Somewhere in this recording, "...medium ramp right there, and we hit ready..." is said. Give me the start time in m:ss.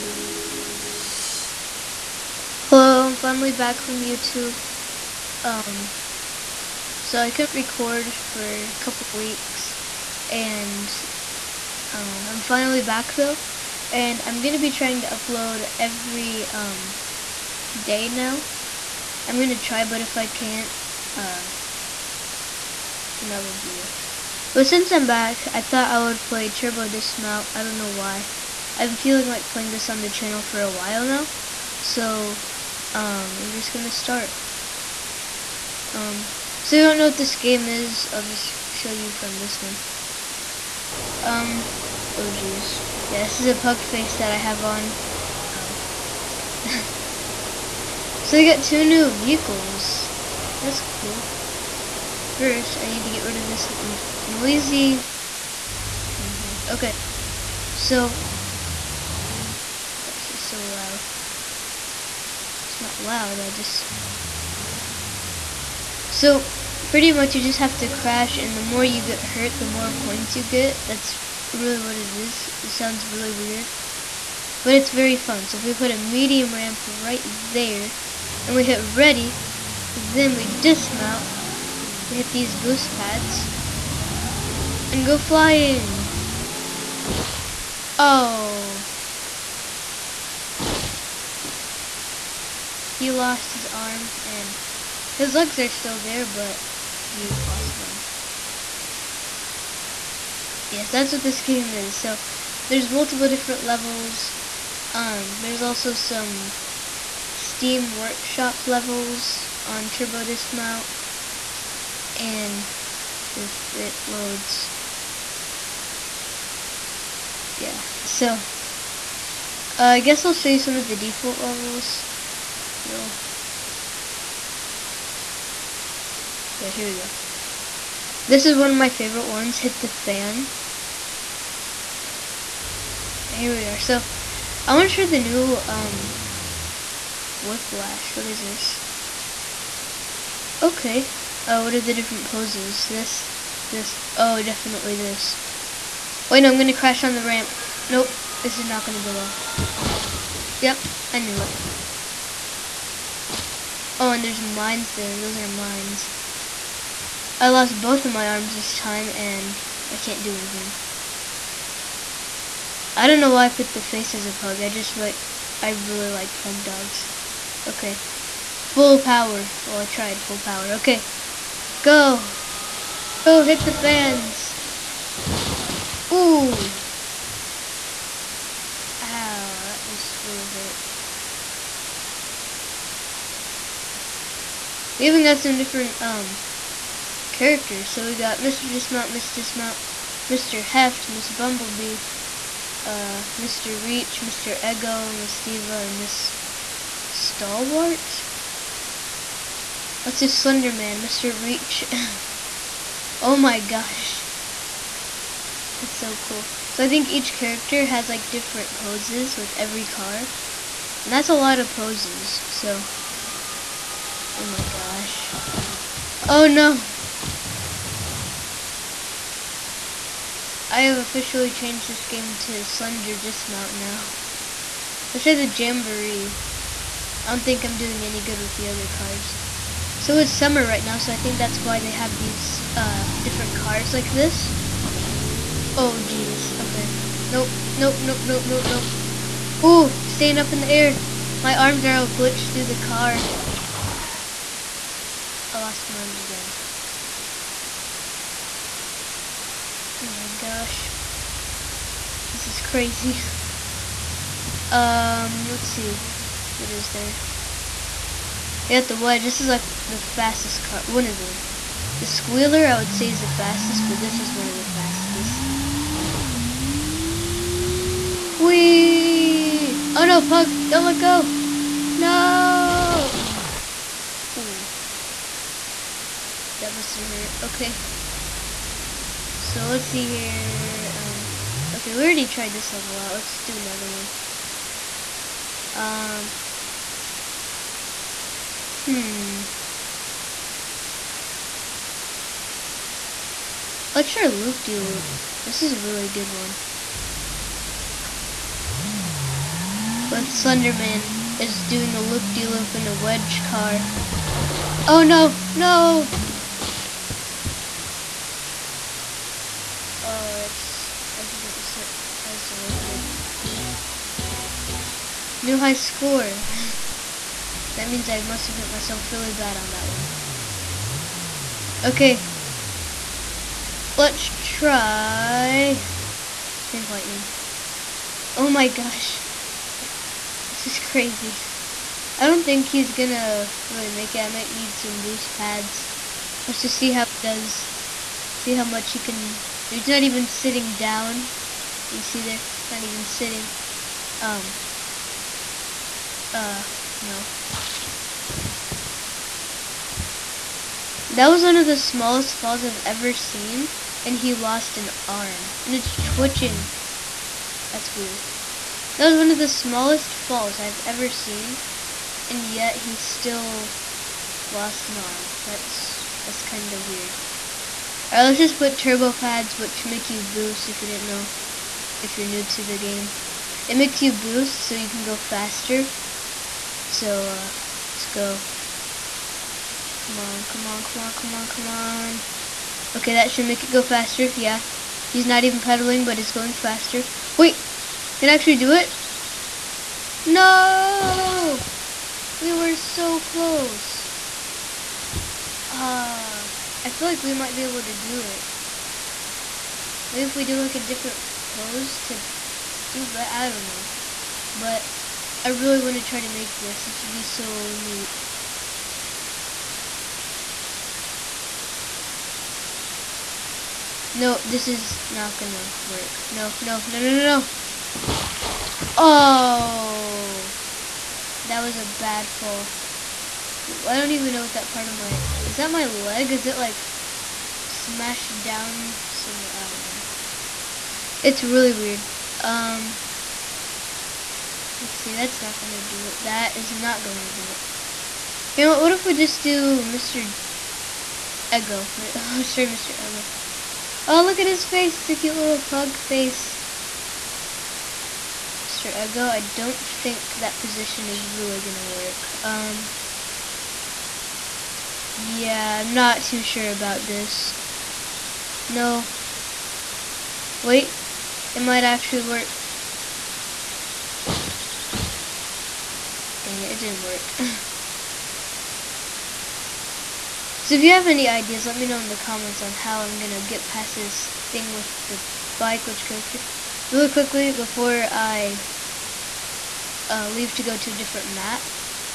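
1:15.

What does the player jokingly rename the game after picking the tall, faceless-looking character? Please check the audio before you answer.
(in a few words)
Slender Dismount.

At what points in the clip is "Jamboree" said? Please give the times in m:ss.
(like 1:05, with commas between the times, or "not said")
3:45.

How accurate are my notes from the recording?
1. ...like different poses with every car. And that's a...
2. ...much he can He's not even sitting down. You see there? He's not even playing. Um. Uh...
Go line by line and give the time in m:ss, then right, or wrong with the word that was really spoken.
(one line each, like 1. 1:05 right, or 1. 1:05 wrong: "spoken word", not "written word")
1. 3:28 right
2. 5:38 wrong: "sitting", not "playing".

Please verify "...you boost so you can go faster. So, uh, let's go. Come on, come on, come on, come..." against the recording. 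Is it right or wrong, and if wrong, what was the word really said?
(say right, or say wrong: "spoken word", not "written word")
right.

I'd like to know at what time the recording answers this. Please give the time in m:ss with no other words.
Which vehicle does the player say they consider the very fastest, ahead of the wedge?
4:22.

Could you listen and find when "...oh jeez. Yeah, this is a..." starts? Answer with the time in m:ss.
0:42.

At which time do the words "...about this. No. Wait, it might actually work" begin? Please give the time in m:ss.
7:36.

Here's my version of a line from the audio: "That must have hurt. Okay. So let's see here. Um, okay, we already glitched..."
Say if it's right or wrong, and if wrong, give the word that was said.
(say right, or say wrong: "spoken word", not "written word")
wrong: "tried", not "glitched".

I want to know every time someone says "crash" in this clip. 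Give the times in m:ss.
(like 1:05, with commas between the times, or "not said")
1:07, 2:26.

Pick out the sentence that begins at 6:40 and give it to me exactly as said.
Maybe if we do like a different pose to do, but I don't know.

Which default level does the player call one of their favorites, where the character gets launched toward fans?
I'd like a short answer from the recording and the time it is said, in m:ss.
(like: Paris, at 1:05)
Hit the Fan, at 2:09.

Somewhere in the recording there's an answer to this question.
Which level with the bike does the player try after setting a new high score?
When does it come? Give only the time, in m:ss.
5:26.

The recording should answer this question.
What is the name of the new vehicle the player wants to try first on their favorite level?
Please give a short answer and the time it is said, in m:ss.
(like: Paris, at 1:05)
Whiplash, at 2:17.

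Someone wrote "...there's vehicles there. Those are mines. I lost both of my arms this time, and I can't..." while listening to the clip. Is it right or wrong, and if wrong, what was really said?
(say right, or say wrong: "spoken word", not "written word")
wrong: "mines", not "vehicles".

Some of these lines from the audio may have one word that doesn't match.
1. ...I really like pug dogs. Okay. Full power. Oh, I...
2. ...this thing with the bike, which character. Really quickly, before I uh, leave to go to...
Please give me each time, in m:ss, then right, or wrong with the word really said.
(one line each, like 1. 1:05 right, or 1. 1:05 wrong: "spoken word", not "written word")
1. 2:45 right
2. 7:53 right.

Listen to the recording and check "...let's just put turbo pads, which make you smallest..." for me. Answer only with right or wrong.
wrong.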